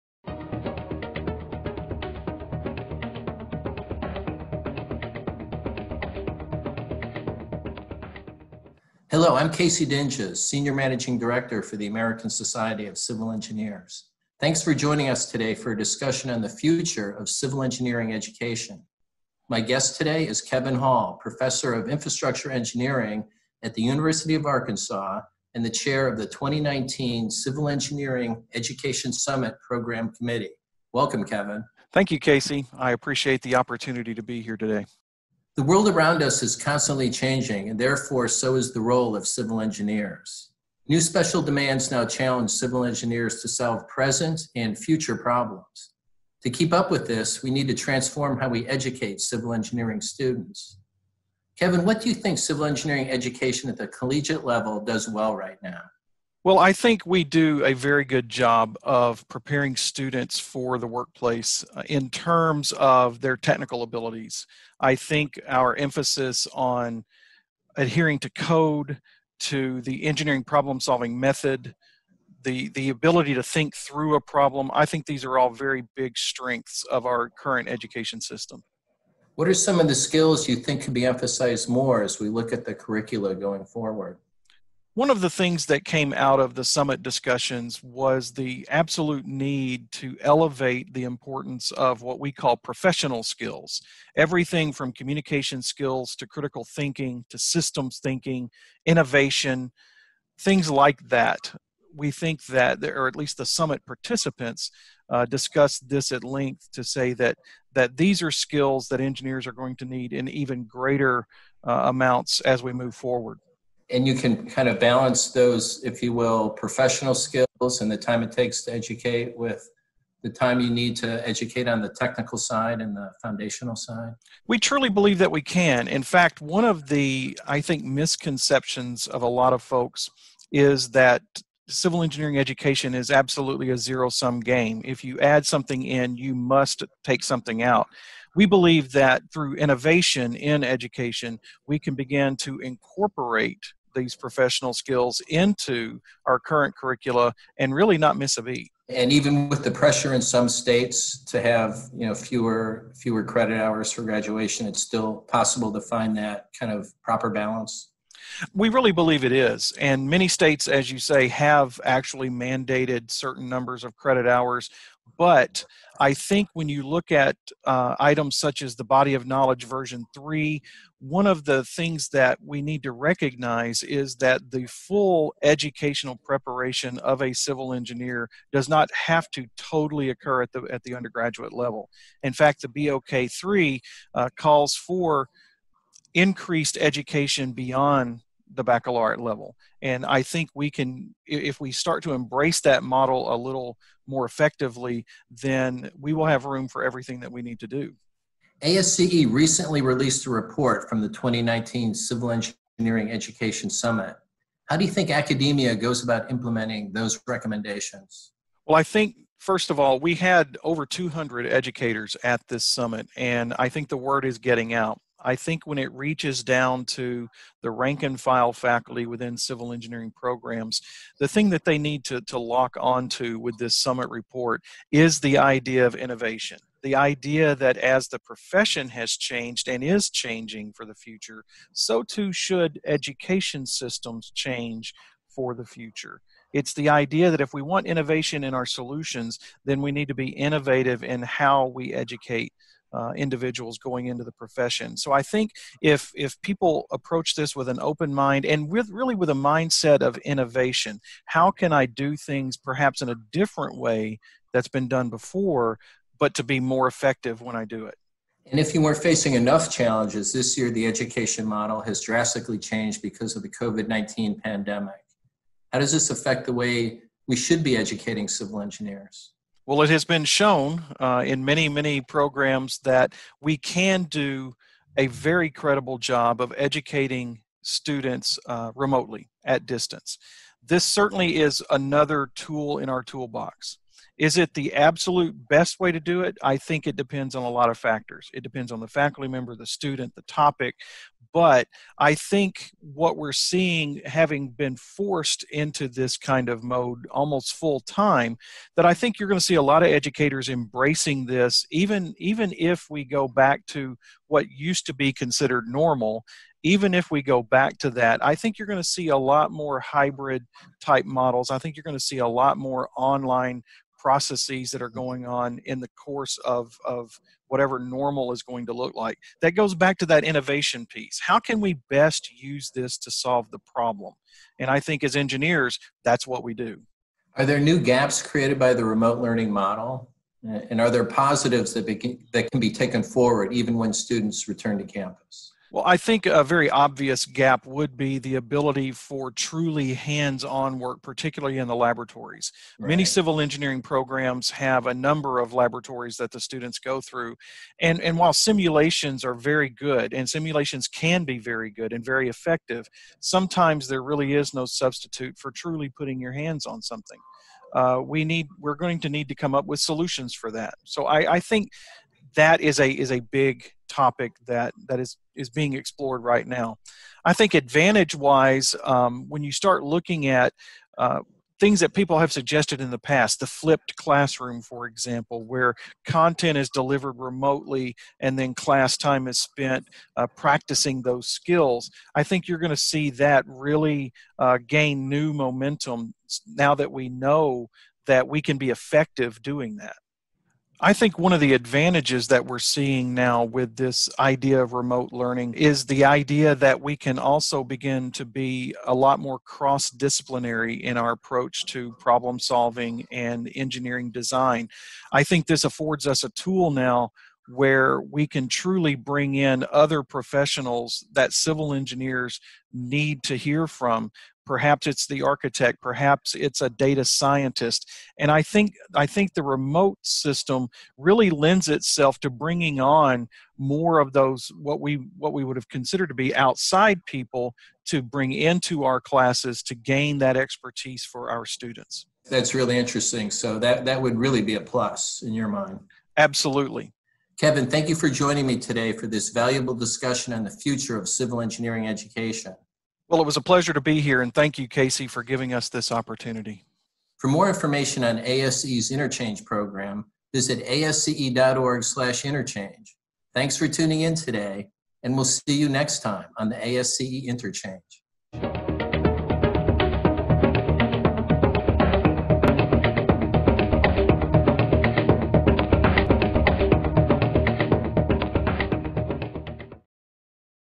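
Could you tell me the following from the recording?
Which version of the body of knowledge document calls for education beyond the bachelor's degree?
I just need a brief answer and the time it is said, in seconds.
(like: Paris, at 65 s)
version 3, at 169 s.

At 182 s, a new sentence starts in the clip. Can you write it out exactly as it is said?
In fact, the BOK 3 uh, calls for increased education beyond the baccalaureate level.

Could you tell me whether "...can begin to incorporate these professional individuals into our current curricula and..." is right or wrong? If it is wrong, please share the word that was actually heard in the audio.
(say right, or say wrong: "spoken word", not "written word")
wrong: "skills", not "individuals".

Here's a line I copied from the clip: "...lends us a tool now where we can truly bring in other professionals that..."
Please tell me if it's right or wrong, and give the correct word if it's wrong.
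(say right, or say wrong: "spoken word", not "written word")
wrong: "affords", not "lends".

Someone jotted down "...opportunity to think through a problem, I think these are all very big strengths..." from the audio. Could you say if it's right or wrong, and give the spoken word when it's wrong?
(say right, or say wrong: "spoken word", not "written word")
wrong: "ability", not "opportunity".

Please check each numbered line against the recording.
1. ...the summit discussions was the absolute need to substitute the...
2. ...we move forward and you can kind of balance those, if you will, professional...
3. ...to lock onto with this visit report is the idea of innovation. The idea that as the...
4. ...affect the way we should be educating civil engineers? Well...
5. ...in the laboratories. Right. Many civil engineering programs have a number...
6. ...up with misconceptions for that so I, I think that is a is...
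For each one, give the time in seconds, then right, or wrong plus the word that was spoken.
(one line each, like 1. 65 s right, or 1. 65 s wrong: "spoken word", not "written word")
1. 86 s wrong: "elevate", not "substitute"
2. 112 s right
3. 222 s wrong: "summit", not "visit"
4. 266 s right
5. 341 s right
6. 359 s wrong: "solutions", not "misconceptions".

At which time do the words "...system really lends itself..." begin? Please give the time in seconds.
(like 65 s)
420 s.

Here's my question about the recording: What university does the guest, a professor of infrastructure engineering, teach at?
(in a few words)
University of Arkansas.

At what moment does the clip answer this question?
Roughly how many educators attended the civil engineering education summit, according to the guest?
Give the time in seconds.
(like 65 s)
210 s.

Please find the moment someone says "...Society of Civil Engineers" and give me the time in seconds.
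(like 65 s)
12 s.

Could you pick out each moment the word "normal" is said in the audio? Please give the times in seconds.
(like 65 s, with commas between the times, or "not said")
305 s, 317 s.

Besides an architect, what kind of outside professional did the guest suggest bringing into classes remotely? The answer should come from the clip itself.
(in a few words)
data scientist.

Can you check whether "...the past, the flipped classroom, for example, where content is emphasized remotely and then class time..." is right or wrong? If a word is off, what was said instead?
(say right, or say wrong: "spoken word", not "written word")
wrong: "delivered", not "emphasized".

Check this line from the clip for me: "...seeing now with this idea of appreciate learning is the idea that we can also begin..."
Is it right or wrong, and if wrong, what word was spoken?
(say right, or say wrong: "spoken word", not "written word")
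wrong: "remote", not "appreciate".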